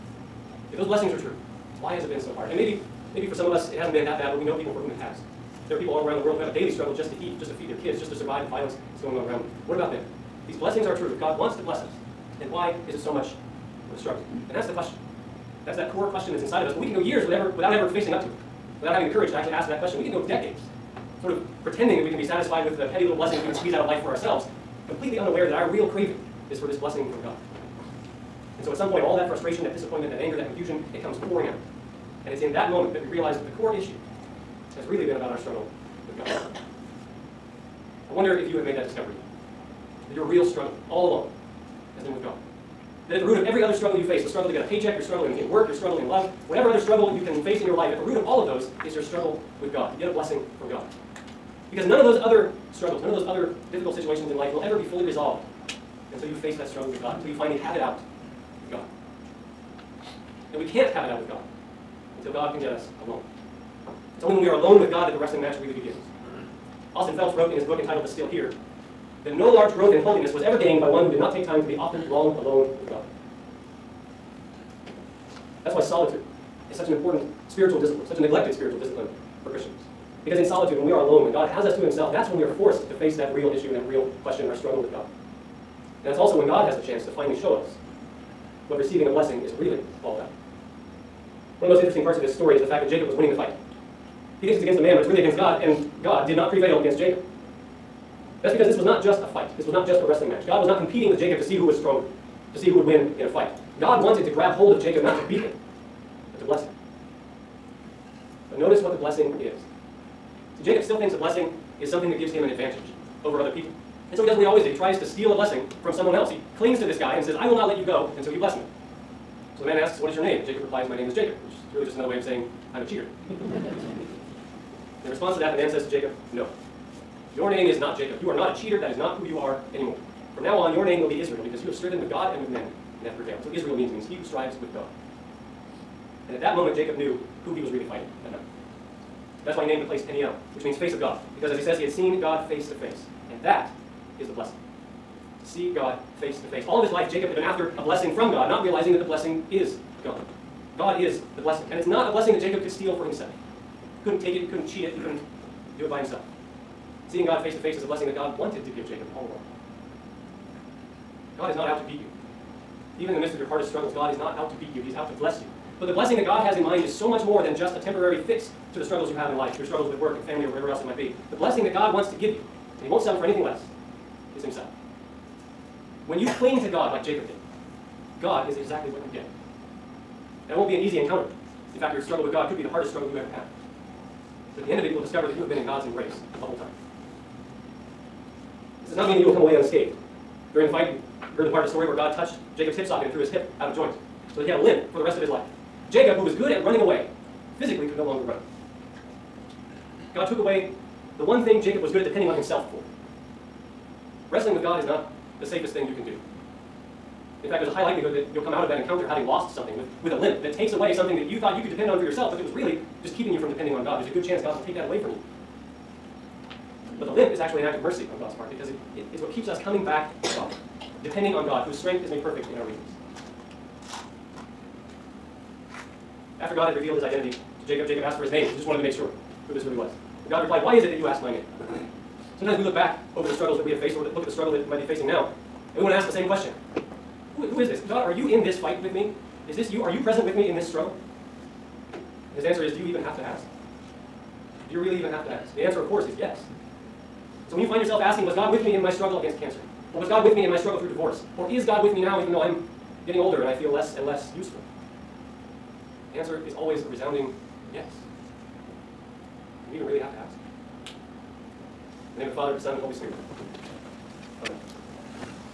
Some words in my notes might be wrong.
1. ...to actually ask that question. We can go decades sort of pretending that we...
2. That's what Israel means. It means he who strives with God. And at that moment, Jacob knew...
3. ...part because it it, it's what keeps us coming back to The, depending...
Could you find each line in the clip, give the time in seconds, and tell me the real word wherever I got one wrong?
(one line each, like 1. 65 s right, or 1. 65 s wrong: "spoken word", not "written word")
1. 19 s right
2. 133 s right
3. 218 s wrong: "God", not "The".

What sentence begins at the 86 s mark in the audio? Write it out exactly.
And that's also when God has the chance to finally show us what receiving a blessing is really all about.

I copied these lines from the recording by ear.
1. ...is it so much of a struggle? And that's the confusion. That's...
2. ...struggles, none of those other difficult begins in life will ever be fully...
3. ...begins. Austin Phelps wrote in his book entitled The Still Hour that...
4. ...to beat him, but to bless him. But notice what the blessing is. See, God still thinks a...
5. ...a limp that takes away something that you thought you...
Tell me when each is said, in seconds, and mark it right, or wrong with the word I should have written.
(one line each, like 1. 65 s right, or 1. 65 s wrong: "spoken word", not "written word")
1. 12 s wrong: "question", not "confusion"
2. 52 s wrong: "situations", not "begins"
3. 65 s right
4. 105 s wrong: "Jacob", not "God"
5. 210 s right.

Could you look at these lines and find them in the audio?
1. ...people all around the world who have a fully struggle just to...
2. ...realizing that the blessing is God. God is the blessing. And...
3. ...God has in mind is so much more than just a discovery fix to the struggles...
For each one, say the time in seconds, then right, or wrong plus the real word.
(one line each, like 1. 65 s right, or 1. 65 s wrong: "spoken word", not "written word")
1. 5 s wrong: "daily", not "fully"
2. 148 s right
3. 166 s wrong: "temporary", not "discovery".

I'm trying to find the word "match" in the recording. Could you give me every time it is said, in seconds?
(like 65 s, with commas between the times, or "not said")
65 s, 100 s.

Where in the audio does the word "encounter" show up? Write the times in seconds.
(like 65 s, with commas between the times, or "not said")
180 s, 208 s.